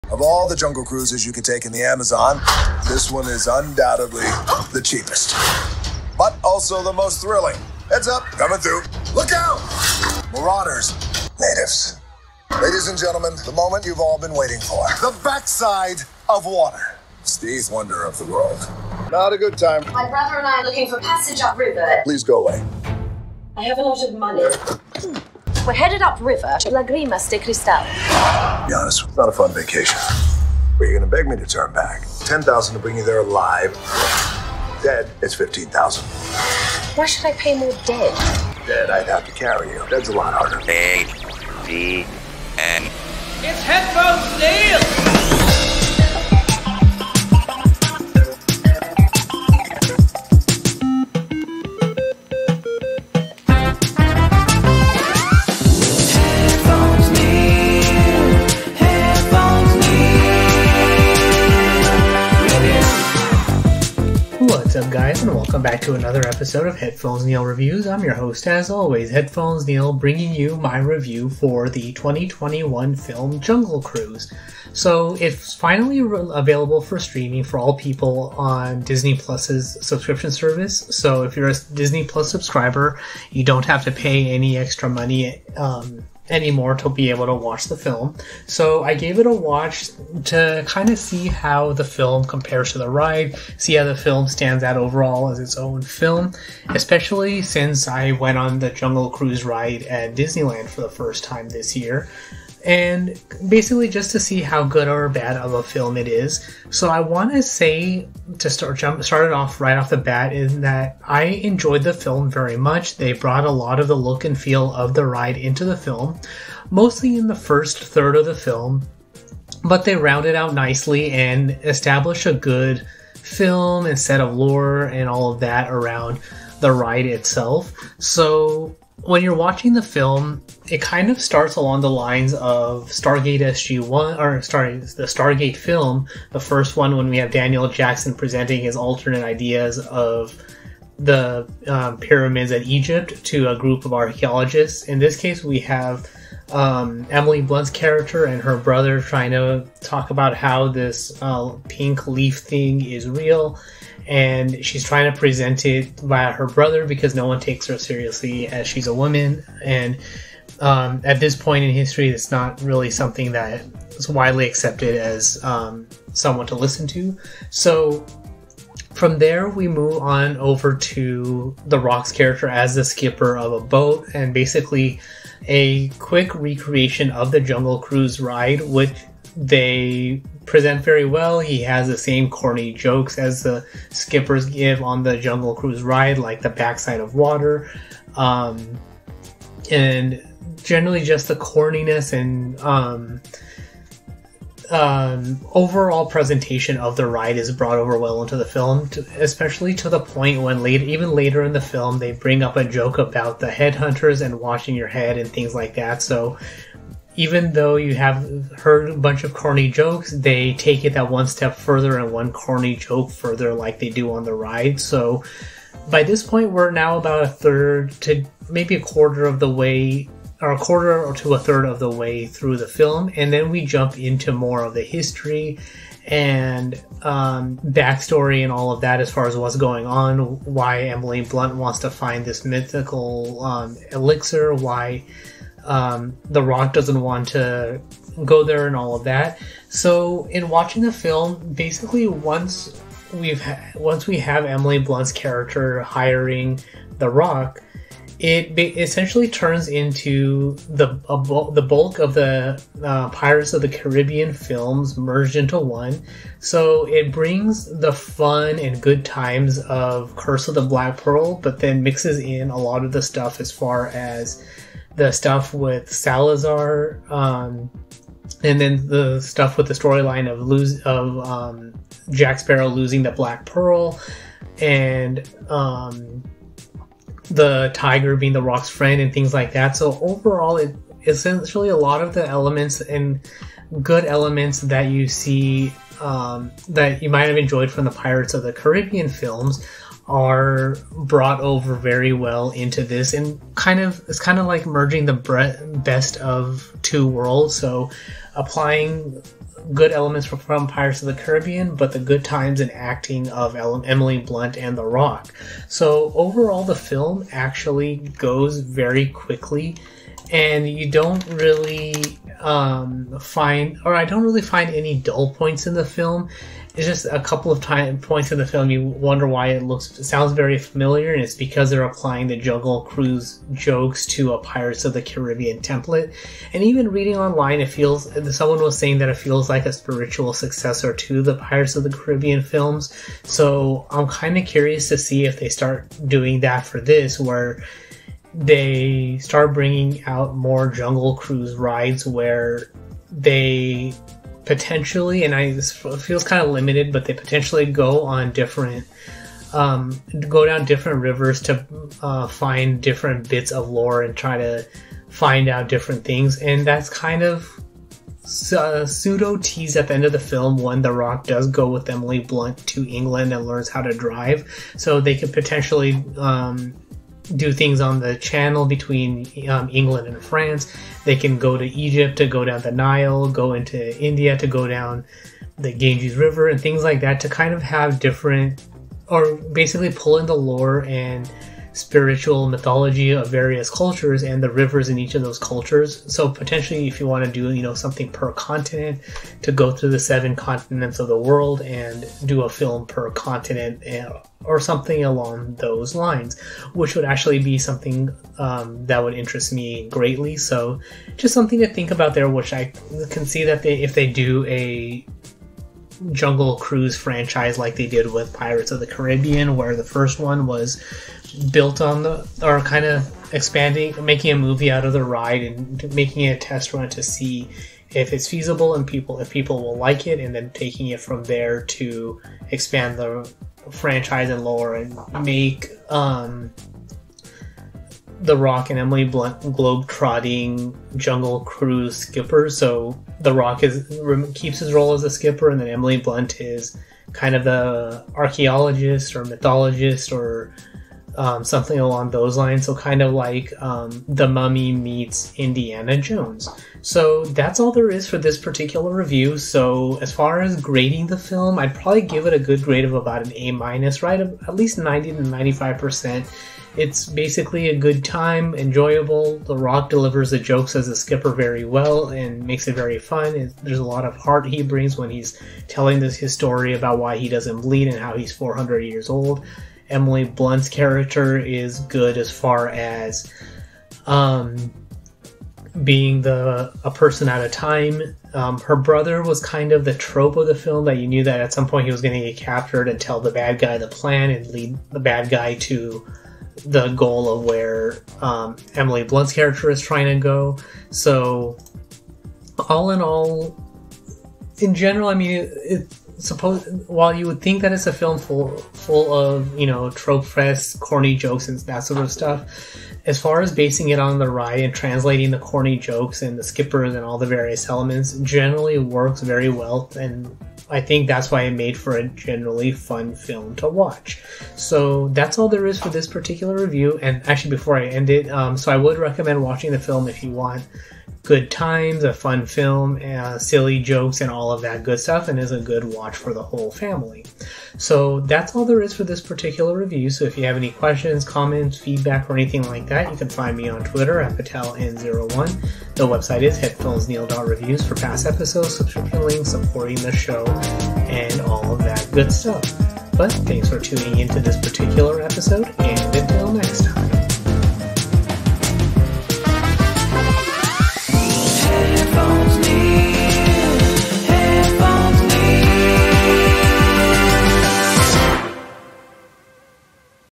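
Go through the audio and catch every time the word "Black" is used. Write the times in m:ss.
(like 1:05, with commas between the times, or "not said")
4:20, 4:33.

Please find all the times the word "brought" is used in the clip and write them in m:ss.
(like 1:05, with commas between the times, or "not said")
1:53, 3:17, 4:50.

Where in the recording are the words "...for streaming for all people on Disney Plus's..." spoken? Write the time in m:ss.
1:16.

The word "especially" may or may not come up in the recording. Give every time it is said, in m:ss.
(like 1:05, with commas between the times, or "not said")
1:36, 3:19.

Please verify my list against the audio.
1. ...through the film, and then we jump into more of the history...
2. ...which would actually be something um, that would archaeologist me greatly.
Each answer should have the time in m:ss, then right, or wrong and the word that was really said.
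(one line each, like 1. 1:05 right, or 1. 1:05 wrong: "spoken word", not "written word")
1. 3:42 right
2. 6:36 wrong: "interest", not "archaeologist".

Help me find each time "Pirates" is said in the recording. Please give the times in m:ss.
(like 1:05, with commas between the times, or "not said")
4:13, 4:47, 5:00, 5:24, 5:31, 6:48.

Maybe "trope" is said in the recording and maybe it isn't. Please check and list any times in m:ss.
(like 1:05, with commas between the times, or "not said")
7:59, 8:19.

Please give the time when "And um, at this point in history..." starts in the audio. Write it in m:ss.
2:39.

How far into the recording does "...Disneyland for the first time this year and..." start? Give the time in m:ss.
1:40.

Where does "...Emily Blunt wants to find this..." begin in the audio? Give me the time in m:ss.
3:50.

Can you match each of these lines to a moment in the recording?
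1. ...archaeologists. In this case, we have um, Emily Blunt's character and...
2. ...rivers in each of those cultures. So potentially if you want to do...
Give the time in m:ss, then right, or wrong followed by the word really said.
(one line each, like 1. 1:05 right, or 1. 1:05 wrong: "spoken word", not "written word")
1. 2:23 right
2. 6:24 right.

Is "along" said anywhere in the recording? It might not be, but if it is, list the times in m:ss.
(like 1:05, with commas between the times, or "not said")
2:11, 6:35, 7:21.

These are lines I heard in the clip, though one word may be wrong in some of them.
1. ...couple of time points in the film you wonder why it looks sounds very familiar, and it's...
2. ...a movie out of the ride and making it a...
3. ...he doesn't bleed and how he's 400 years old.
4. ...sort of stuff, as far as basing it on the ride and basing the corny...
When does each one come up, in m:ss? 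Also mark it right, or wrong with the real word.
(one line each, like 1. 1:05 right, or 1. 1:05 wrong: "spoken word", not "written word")
1. 5:17 right
2. 6:54 right
3. 7:47 right
4. 8:21 wrong: "translating", not "basing".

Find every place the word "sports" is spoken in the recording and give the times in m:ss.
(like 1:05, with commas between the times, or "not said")
not said.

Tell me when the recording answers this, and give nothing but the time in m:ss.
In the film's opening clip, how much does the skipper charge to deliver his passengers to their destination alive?
0:32.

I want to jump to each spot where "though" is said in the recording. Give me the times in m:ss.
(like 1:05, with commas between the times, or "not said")
3:27.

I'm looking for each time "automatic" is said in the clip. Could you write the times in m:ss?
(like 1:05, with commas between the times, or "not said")
not said.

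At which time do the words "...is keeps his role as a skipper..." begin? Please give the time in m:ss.
7:13.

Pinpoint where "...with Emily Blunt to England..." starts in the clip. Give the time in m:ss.
6:01.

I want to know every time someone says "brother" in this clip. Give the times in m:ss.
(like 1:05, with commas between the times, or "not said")
0:20, 2:28, 2:36, 7:58.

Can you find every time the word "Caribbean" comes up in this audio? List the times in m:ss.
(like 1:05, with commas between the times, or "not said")
4:13, 4:48, 5:01, 5:25, 5:31, 6:48.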